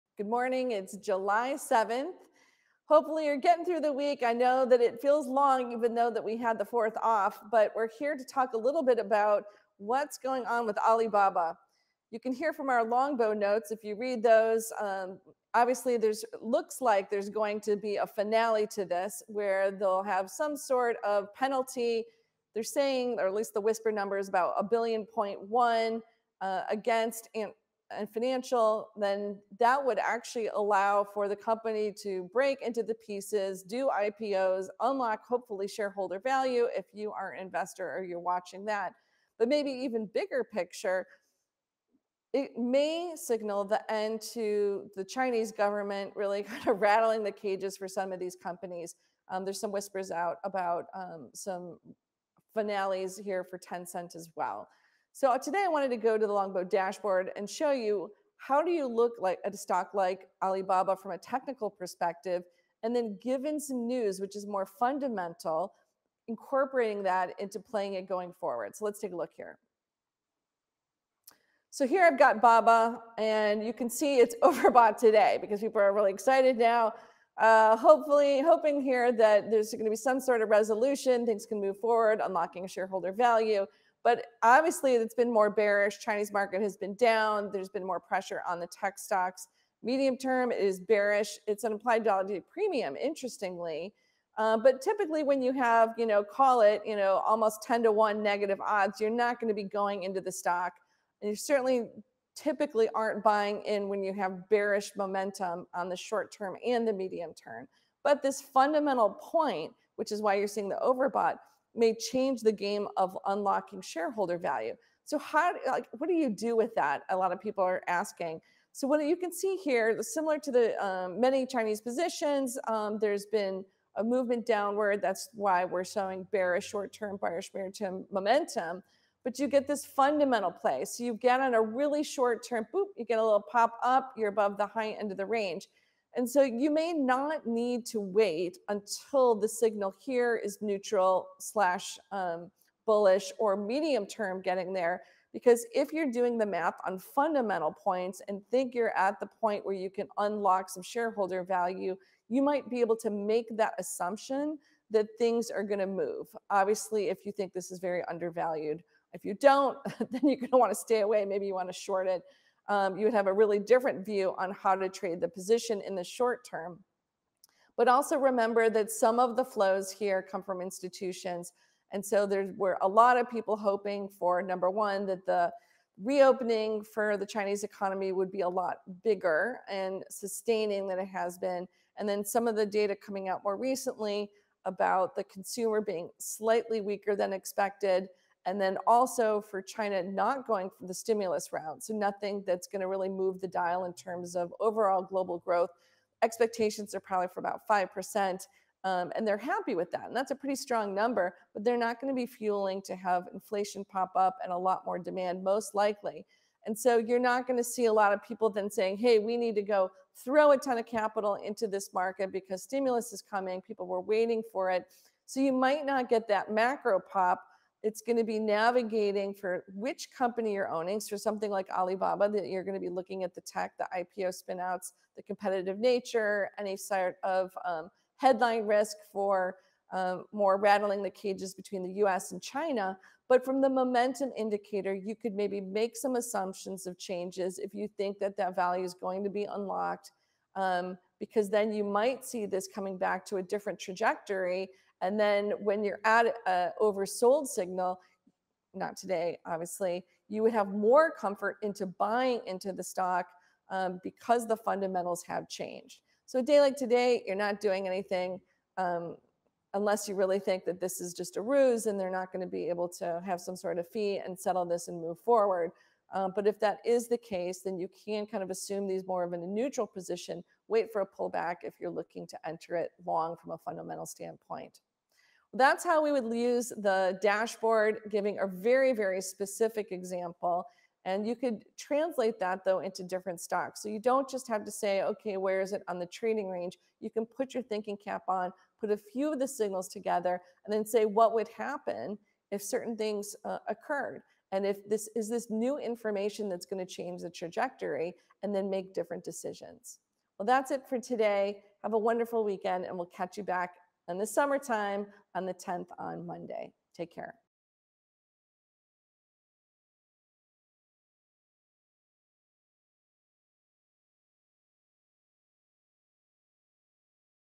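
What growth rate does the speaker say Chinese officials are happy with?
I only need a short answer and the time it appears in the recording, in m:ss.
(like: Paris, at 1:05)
5%, at 3:17.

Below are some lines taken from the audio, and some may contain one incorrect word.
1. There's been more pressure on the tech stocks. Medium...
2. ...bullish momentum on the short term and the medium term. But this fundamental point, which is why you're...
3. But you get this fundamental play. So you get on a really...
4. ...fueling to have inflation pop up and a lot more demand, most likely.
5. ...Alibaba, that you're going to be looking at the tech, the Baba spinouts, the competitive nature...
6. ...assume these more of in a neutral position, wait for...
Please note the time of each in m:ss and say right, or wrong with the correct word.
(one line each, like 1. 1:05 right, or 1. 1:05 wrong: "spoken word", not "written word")
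1. 1:27 right
2. 1:44 wrong: "bearish", not "bullish"
3. 2:09 right
4. 3:22 right
5. 3:41 wrong: "IPO", not "Baba"
6. 4:28 right.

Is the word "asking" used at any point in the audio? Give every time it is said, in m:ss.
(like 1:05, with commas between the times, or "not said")
1:57.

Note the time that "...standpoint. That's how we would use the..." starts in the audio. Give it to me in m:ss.
4:34.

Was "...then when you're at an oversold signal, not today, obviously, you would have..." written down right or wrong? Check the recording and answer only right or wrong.
right.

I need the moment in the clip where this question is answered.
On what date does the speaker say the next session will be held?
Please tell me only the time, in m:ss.
5:05.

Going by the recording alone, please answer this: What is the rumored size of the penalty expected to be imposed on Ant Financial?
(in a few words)
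1.1 billion.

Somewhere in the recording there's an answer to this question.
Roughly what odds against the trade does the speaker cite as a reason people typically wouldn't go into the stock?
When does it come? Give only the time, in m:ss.
1:37.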